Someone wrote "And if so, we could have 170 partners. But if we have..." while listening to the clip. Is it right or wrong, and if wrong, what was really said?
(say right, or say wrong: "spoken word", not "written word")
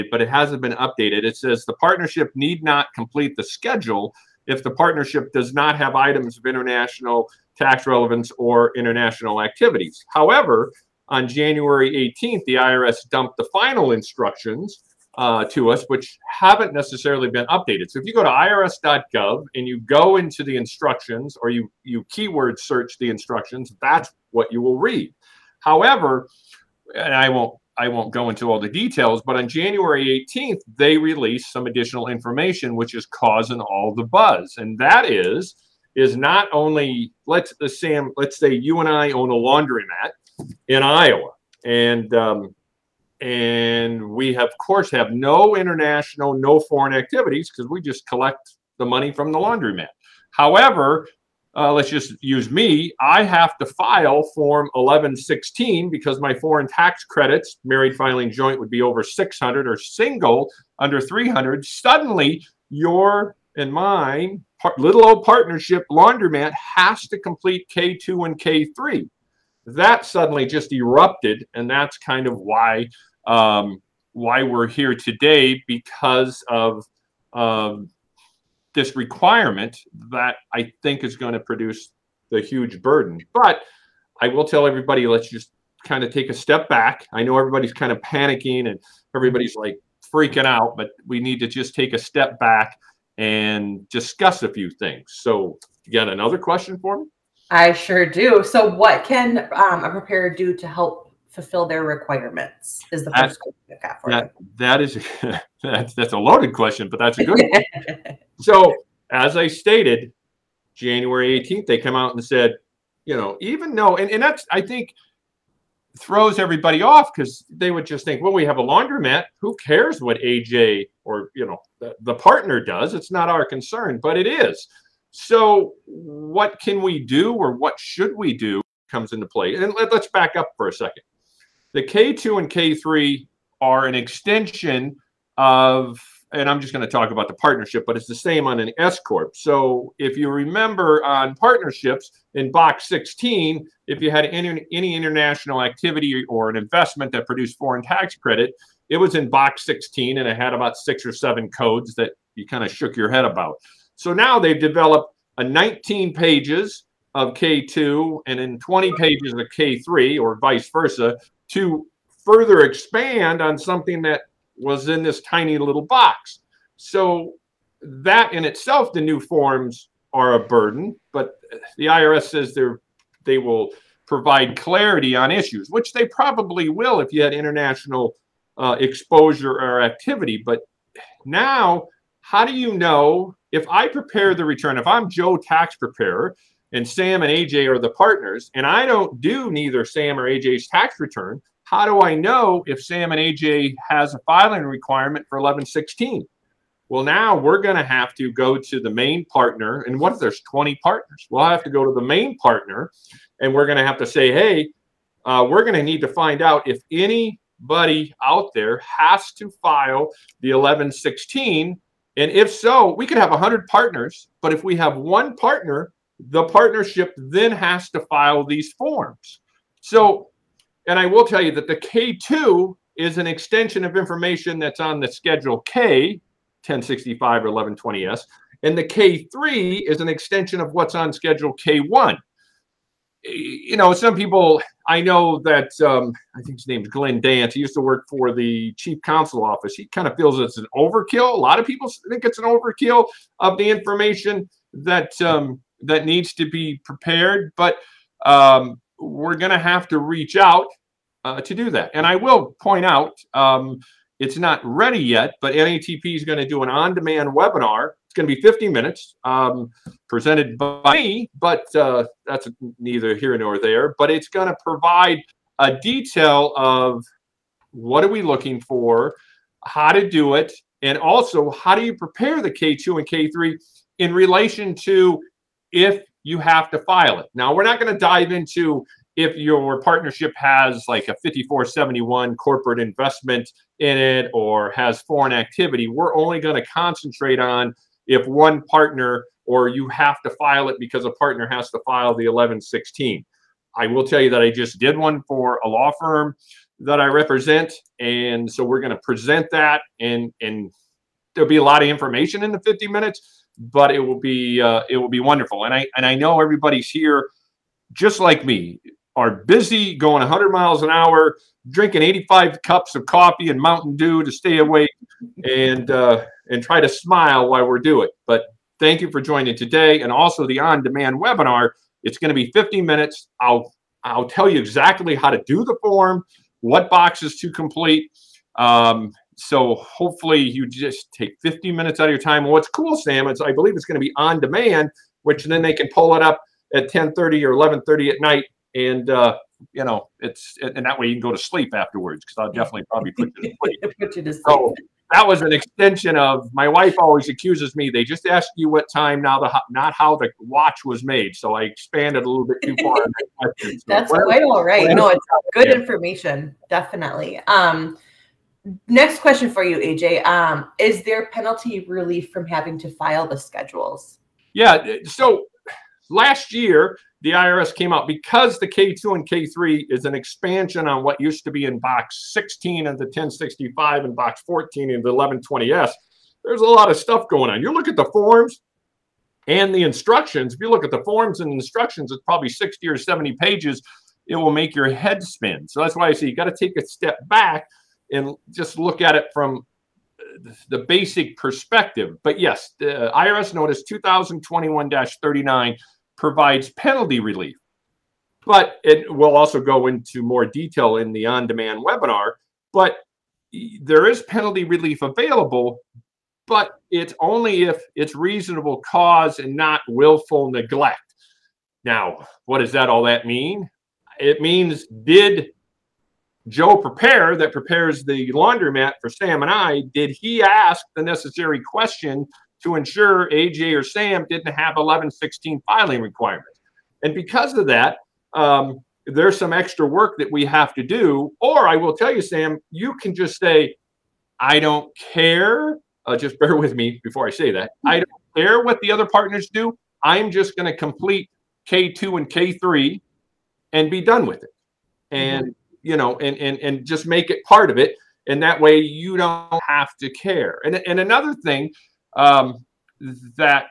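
wrong: "100", not "170".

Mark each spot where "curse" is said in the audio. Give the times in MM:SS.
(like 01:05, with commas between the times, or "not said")
not said.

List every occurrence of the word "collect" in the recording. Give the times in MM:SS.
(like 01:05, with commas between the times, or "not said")
00:48.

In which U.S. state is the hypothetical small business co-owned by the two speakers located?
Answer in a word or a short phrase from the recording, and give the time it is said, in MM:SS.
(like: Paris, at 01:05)
Iowa, at 00:40.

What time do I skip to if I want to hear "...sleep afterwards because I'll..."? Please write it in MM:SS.
05:41.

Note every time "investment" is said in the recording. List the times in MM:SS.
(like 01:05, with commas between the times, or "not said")
02:26, 04:42.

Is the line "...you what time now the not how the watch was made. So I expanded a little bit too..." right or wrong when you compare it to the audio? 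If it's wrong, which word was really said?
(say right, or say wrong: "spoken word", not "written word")
right.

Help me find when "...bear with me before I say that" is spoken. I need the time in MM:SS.
07:16.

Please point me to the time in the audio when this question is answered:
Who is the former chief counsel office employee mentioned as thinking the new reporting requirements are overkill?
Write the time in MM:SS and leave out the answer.
03:56.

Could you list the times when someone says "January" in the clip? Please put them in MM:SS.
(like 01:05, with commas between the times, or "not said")
00:11, 00:29, 01:50.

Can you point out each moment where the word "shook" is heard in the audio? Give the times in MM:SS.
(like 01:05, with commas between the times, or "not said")
02:32.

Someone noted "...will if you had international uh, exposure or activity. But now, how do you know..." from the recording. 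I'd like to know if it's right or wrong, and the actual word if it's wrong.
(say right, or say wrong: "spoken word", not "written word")
right.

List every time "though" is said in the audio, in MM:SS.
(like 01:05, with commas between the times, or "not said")
01:53.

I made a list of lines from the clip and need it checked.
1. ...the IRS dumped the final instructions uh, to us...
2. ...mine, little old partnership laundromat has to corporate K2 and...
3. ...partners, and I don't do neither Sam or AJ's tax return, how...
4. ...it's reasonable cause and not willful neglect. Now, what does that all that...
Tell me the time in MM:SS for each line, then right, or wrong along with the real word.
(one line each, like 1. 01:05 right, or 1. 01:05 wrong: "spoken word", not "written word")
1. 00:12 right
2. 01:03 wrong: "complete", not "corporate"
3. 03:07 right
4. 06:47 right.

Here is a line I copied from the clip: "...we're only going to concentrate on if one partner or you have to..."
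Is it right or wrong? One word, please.
right.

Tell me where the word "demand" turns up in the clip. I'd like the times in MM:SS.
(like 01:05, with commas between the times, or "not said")
04:16, 05:20, 05:34, 06:41.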